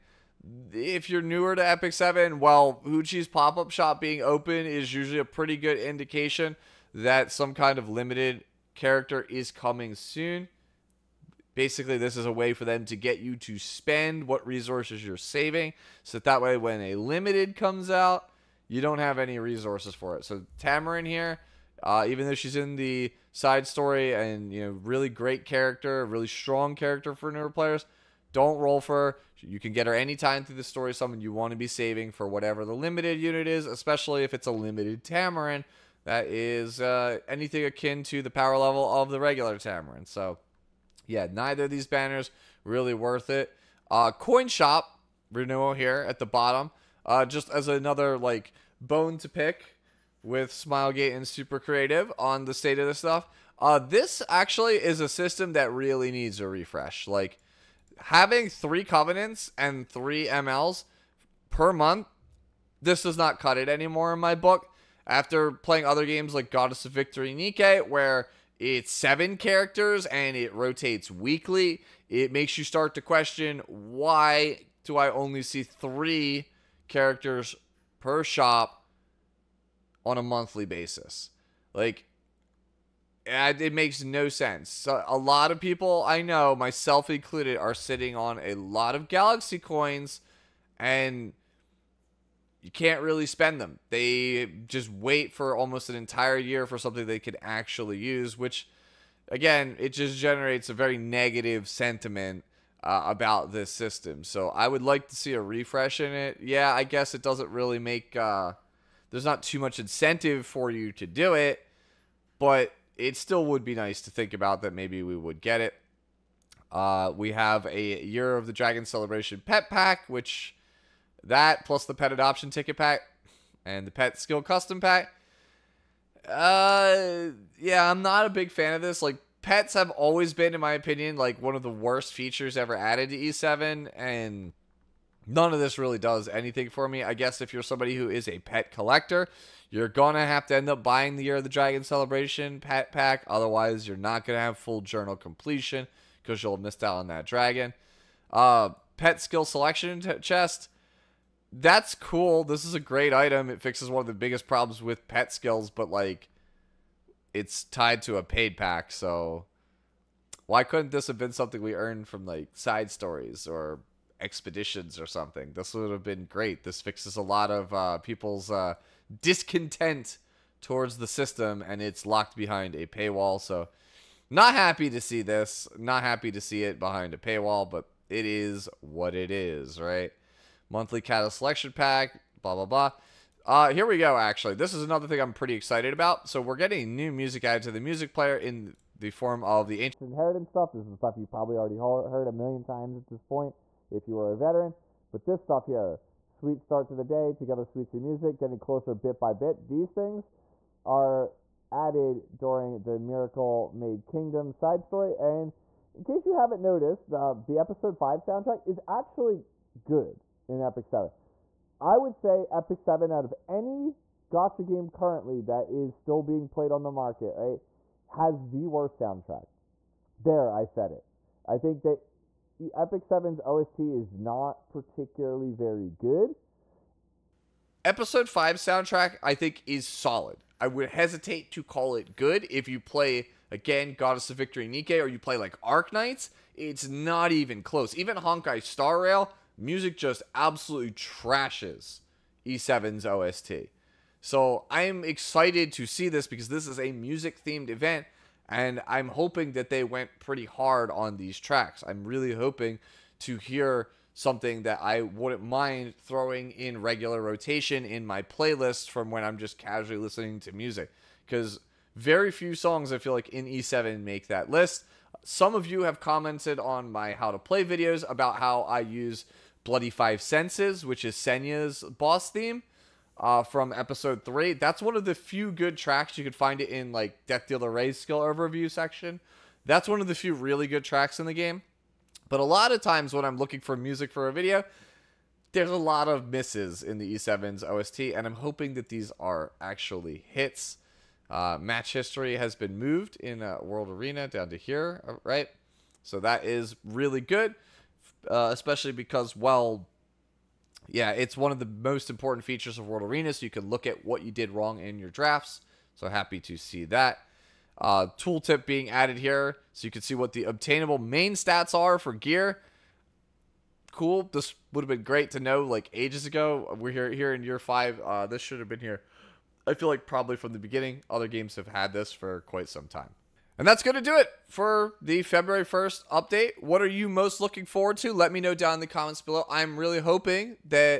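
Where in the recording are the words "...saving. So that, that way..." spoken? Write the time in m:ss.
0:15.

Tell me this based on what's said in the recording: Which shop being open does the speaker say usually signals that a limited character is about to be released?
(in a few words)
Hoochie's pop up shop.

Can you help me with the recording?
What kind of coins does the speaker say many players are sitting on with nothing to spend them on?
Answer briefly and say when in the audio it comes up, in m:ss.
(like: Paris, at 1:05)
Galaxy coins, at 1:29.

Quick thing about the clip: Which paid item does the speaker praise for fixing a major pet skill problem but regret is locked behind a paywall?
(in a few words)
Pet skill selection chest.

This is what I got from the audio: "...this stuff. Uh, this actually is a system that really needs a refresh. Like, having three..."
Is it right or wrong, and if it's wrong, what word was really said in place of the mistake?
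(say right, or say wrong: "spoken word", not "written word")
right.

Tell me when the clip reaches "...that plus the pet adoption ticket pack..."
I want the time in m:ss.
2:01.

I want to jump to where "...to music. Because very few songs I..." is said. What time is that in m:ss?
4:20.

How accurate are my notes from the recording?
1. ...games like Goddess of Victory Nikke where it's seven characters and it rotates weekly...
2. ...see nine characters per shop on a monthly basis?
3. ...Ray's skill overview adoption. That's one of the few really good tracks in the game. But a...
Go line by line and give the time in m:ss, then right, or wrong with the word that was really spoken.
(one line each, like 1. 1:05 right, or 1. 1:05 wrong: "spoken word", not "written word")
1. 1:06 right
2. 1:15 wrong: "three", not "nine"
3. 4:37 wrong: "section", not "adoption".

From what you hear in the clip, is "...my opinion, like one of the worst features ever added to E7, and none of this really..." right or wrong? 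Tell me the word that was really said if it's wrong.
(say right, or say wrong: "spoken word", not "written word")
right.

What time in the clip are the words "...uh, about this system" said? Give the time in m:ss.
1:42.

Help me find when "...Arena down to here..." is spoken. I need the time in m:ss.
4:53.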